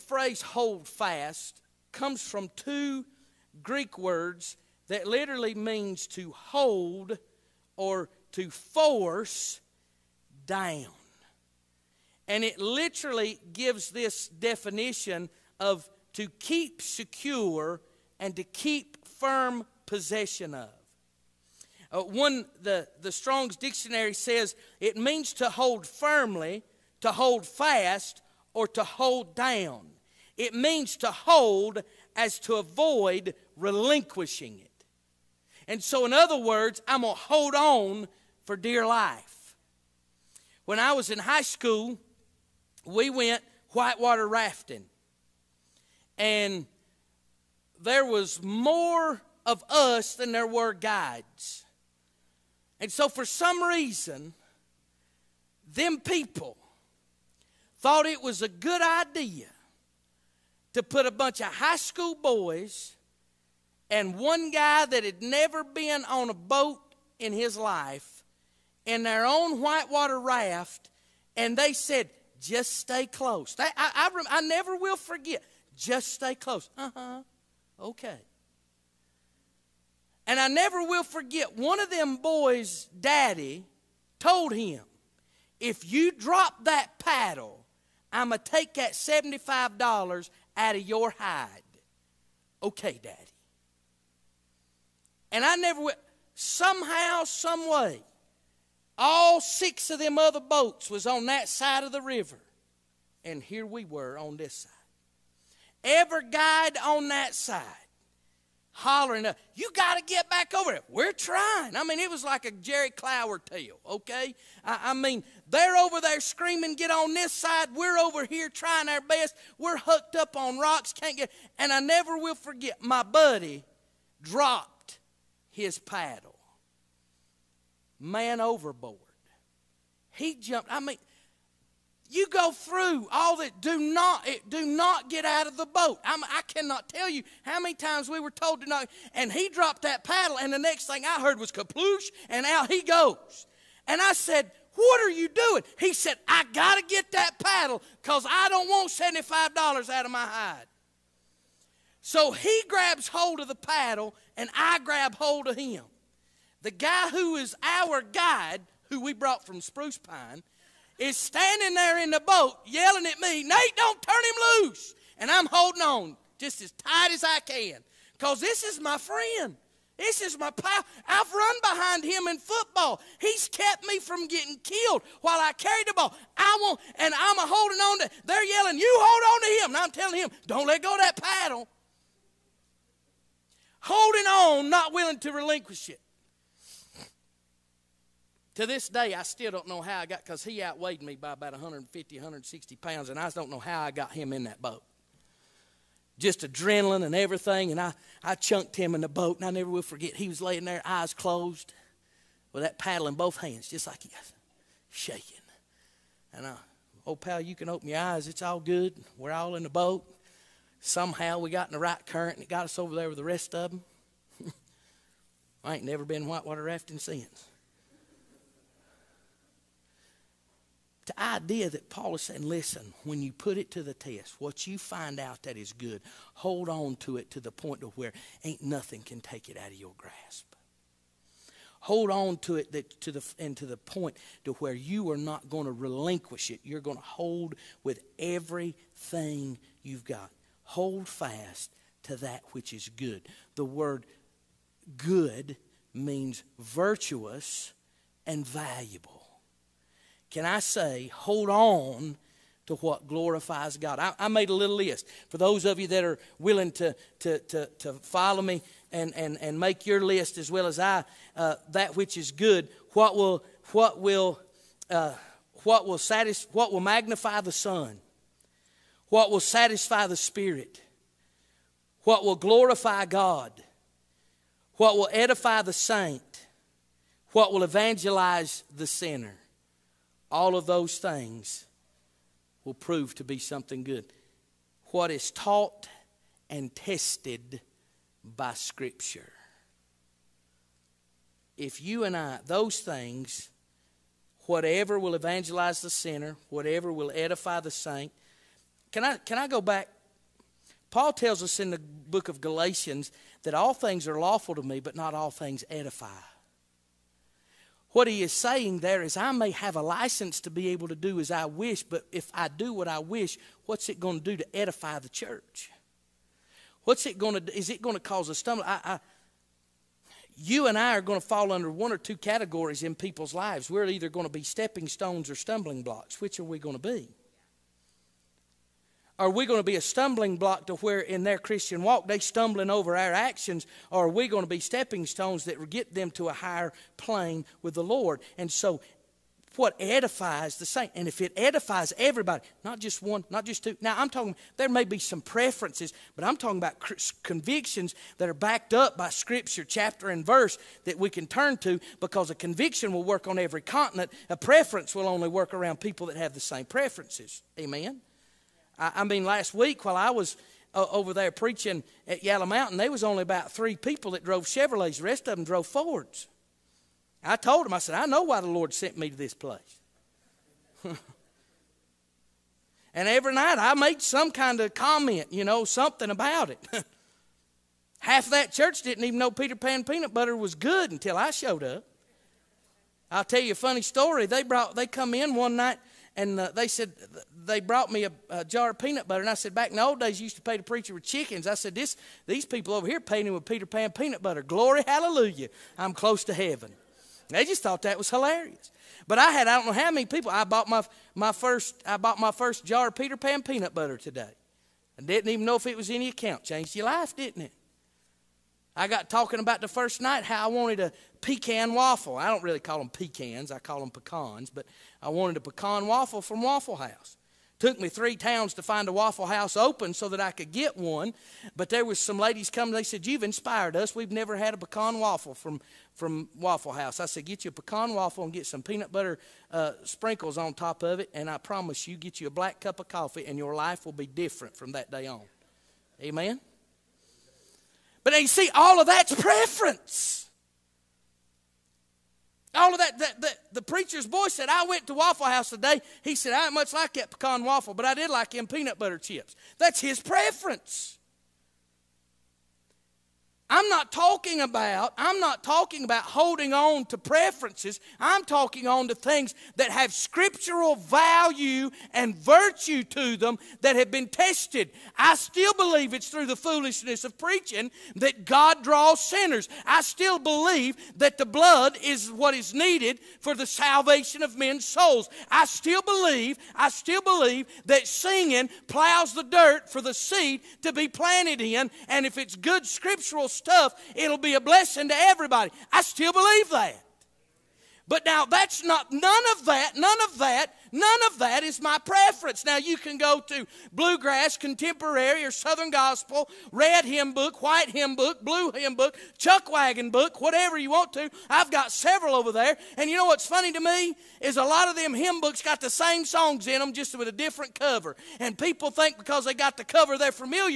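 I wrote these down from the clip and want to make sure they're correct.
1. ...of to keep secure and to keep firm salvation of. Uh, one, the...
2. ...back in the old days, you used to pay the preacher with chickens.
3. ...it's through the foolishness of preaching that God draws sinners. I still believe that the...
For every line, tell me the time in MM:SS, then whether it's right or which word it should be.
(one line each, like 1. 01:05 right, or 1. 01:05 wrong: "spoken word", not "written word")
1. 00:15 wrong: "possession", not "salvation"
2. 06:29 right
3. 07:45 right.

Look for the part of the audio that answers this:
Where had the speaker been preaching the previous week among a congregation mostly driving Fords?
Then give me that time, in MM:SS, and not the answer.
06:02.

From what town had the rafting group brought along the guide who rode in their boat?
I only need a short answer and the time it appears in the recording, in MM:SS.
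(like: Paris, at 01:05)
Spruce Pine, at 02:39.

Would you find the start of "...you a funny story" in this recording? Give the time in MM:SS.
06:23.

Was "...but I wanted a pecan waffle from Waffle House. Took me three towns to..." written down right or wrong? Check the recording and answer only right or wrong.
right.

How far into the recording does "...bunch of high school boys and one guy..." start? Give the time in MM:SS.
01:01.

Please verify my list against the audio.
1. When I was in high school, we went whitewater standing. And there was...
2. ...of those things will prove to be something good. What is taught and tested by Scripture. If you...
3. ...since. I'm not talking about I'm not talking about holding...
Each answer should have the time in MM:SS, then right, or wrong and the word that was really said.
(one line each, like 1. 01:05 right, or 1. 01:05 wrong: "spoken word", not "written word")
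1. 00:40 wrong: "rafting", not "standing"
2. 04:40 right
3. 07:29 wrong: "preference", not "since".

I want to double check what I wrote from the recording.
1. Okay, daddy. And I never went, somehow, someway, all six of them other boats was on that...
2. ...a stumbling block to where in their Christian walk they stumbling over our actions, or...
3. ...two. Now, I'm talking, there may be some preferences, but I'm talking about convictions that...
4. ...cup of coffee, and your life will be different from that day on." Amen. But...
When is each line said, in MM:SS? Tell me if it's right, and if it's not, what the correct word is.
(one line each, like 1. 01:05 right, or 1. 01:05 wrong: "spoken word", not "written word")
1. 01:32 right
2. 05:29 right
3. 05:43 right
4. 07:12 right.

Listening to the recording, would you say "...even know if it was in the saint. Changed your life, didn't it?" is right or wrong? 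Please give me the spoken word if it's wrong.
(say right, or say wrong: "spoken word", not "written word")
wrong: "account", not "saint".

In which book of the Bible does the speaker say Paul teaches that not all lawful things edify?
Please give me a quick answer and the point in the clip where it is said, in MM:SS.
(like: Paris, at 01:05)
Galatians, at 05:02.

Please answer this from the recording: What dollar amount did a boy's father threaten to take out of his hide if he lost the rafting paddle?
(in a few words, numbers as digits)
$75.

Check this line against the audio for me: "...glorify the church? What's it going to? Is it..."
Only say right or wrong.
wrong.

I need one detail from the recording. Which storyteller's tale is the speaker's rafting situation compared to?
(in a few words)
Jerry Clower.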